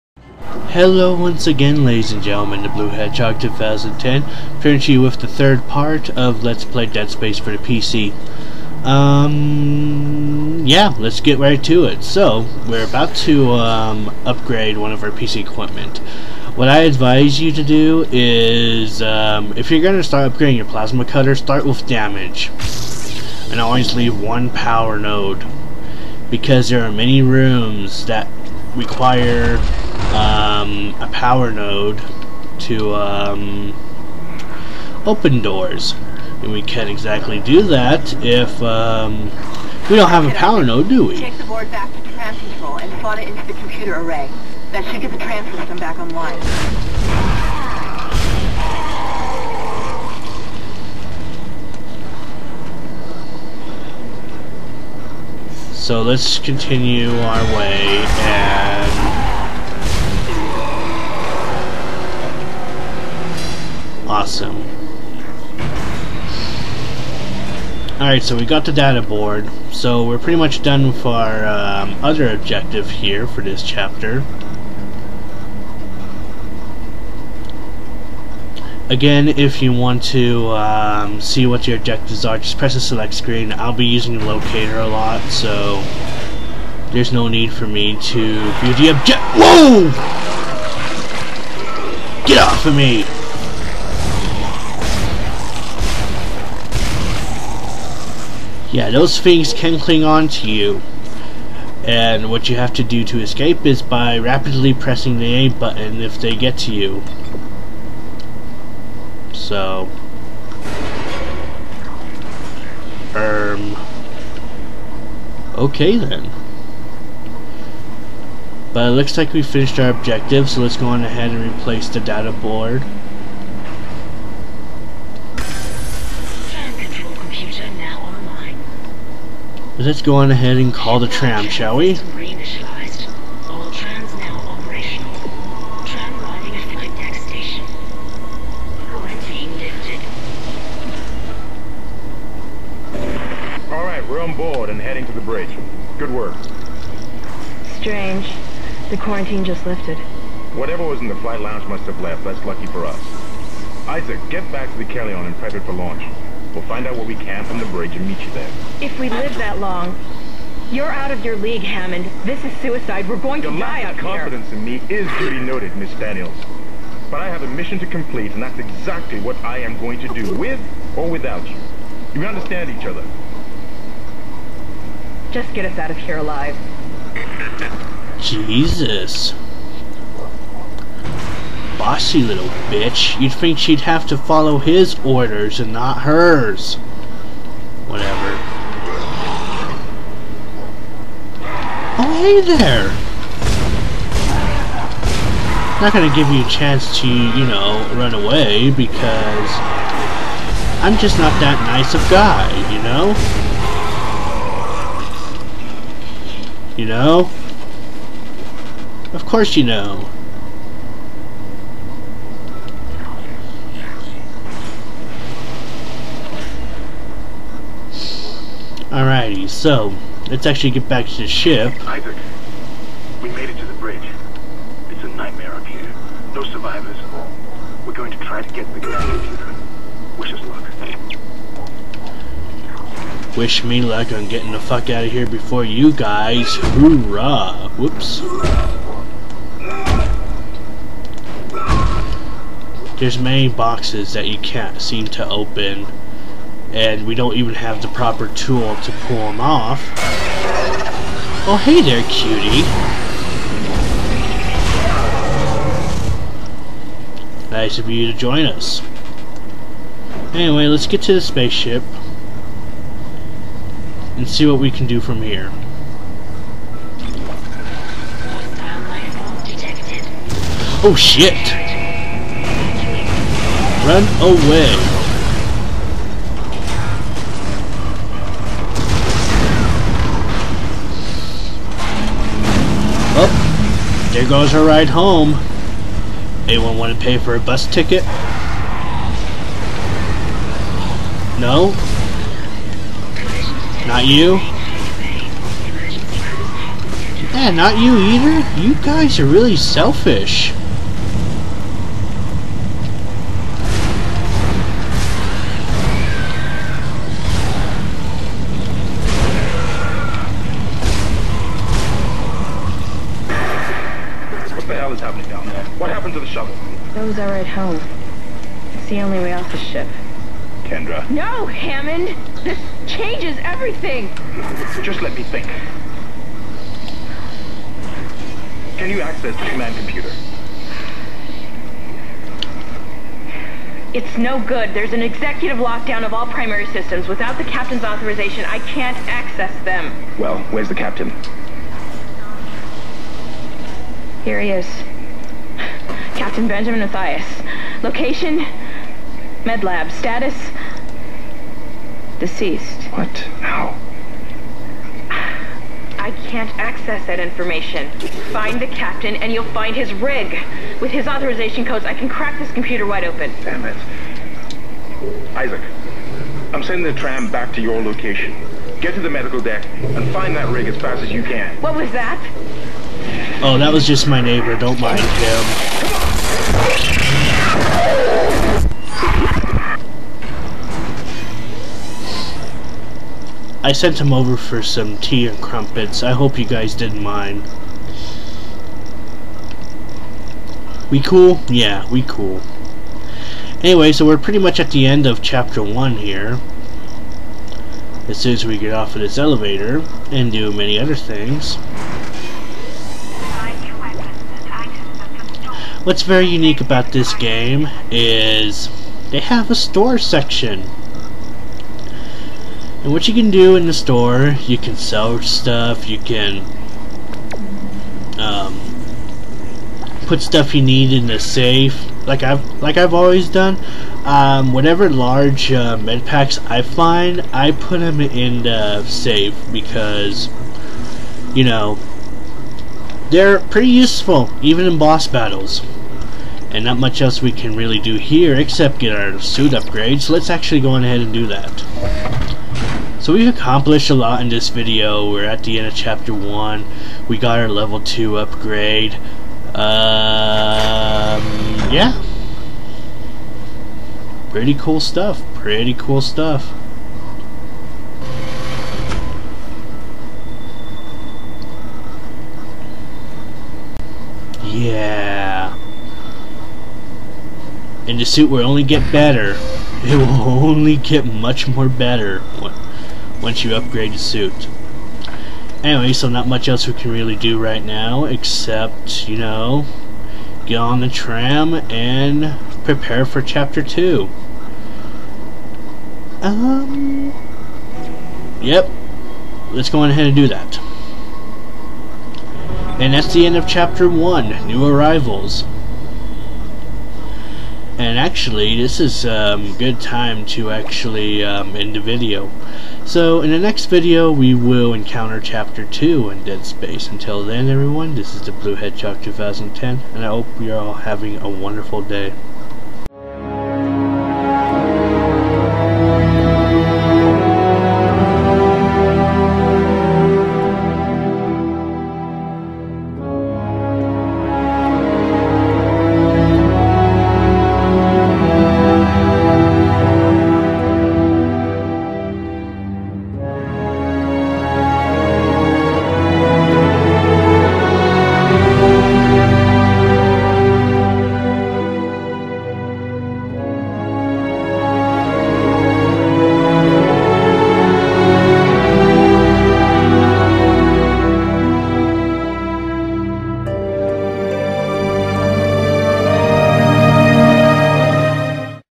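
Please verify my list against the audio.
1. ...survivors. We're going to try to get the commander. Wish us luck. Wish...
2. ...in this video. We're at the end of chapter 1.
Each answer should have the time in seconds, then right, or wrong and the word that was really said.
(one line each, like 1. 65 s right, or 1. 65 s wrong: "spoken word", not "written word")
1. 226 s right
2. 444 s right.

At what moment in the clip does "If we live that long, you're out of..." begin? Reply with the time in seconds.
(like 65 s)
158 s.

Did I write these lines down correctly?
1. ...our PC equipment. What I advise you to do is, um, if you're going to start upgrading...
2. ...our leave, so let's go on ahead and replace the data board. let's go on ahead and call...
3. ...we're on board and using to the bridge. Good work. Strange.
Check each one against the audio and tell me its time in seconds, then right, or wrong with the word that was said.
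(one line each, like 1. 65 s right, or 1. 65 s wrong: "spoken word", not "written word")
1. 15 s right
2. 119 s wrong: "objective", not "leave"
3. 144 s wrong: "heading", not "using".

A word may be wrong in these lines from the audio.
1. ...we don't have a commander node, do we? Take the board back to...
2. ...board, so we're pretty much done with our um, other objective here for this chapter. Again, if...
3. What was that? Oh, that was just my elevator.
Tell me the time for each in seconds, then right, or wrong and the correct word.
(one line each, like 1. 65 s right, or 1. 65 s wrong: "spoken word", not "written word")
1. 39 s wrong: "power", not "commander"
2. 69 s right
3. 371 s wrong: "neighbor", not "elevator".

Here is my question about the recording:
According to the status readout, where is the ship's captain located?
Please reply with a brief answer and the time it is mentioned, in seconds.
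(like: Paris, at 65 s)
Med lab, at 349 s.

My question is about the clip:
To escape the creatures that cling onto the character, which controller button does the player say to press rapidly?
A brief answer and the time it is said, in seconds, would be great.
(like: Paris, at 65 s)
A button, at 105 s.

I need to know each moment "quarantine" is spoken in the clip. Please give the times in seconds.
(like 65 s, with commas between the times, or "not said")
148 s.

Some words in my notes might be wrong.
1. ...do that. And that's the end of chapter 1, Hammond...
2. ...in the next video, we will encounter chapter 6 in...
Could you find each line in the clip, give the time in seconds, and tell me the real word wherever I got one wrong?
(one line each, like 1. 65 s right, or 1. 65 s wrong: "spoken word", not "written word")
1. 490 s wrong: "New", not "Hammond"
2. 503 s wrong: "2", not "6".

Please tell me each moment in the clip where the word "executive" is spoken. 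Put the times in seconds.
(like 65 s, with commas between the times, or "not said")
335 s.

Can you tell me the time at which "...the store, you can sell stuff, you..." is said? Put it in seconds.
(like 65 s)
413 s.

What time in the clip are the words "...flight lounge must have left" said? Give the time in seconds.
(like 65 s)
151 s.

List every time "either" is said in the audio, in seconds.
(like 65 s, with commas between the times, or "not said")
297 s.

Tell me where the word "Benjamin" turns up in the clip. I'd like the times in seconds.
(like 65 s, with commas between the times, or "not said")
346 s.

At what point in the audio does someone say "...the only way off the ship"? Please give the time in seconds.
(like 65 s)
318 s.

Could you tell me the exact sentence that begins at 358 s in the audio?
Find the captain and you'll find his rig.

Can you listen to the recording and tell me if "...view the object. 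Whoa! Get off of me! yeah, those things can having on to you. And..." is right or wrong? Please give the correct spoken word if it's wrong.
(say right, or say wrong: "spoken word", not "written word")
wrong: "cling", not "having".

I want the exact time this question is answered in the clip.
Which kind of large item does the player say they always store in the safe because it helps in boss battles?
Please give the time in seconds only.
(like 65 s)
425 s.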